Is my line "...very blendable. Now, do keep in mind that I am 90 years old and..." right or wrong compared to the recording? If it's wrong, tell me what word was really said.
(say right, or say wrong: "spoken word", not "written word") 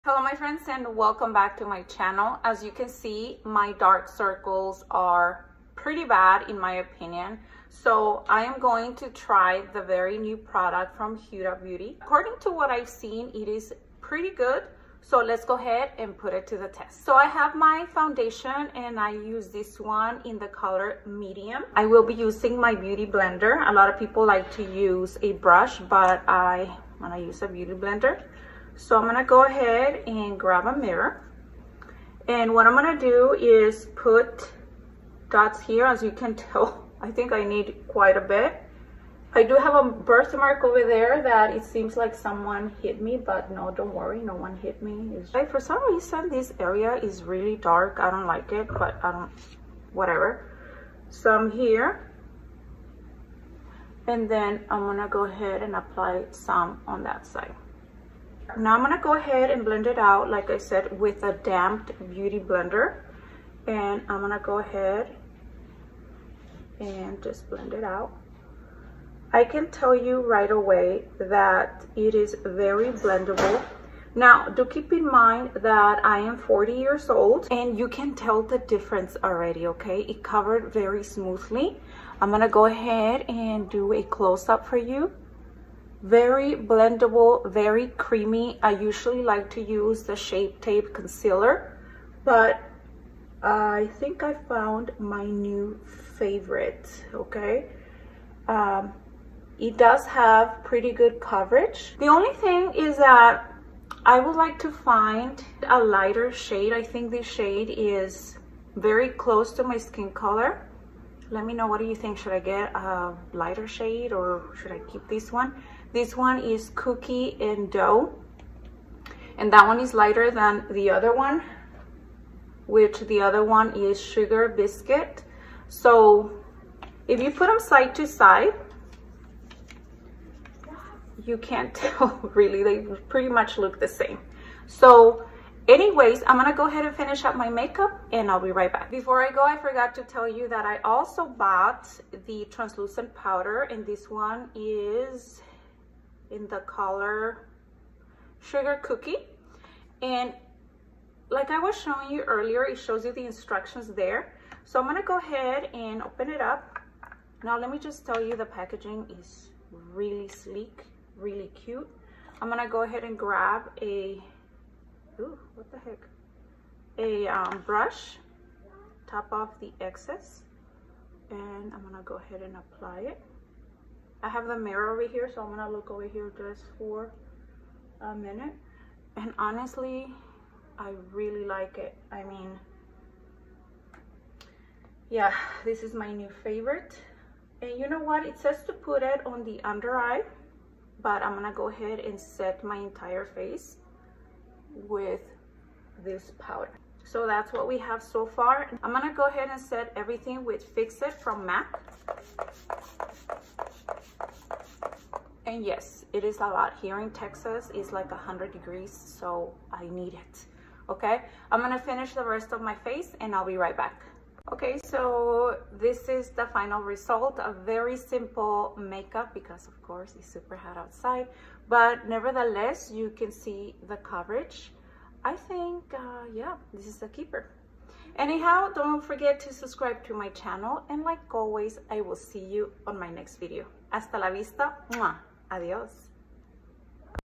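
wrong: "40", not "90".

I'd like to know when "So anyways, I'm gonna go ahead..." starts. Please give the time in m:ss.
2:14.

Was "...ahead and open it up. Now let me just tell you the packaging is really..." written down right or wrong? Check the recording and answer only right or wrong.
right.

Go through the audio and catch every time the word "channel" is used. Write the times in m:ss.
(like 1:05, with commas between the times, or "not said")
0:01, 3:50.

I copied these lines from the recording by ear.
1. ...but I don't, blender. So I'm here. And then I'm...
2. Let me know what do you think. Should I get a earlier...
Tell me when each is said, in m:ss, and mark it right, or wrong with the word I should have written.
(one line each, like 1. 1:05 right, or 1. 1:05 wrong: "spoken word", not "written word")
1. 0:48 wrong: "whatever", not "blender"
2. 1:51 wrong: "lighter", not "earlier".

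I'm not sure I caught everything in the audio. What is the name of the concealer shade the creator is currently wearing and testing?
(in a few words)
Cookie and dough.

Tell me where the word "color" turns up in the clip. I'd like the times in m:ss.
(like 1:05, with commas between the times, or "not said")
0:20, 1:50, 2:26.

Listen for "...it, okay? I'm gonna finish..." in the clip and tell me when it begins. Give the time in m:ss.
3:30.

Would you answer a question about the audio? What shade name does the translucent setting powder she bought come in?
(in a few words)
Sugar Cookie.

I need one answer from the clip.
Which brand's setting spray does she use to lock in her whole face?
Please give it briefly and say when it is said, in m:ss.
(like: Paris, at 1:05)
MAC, at 3:21.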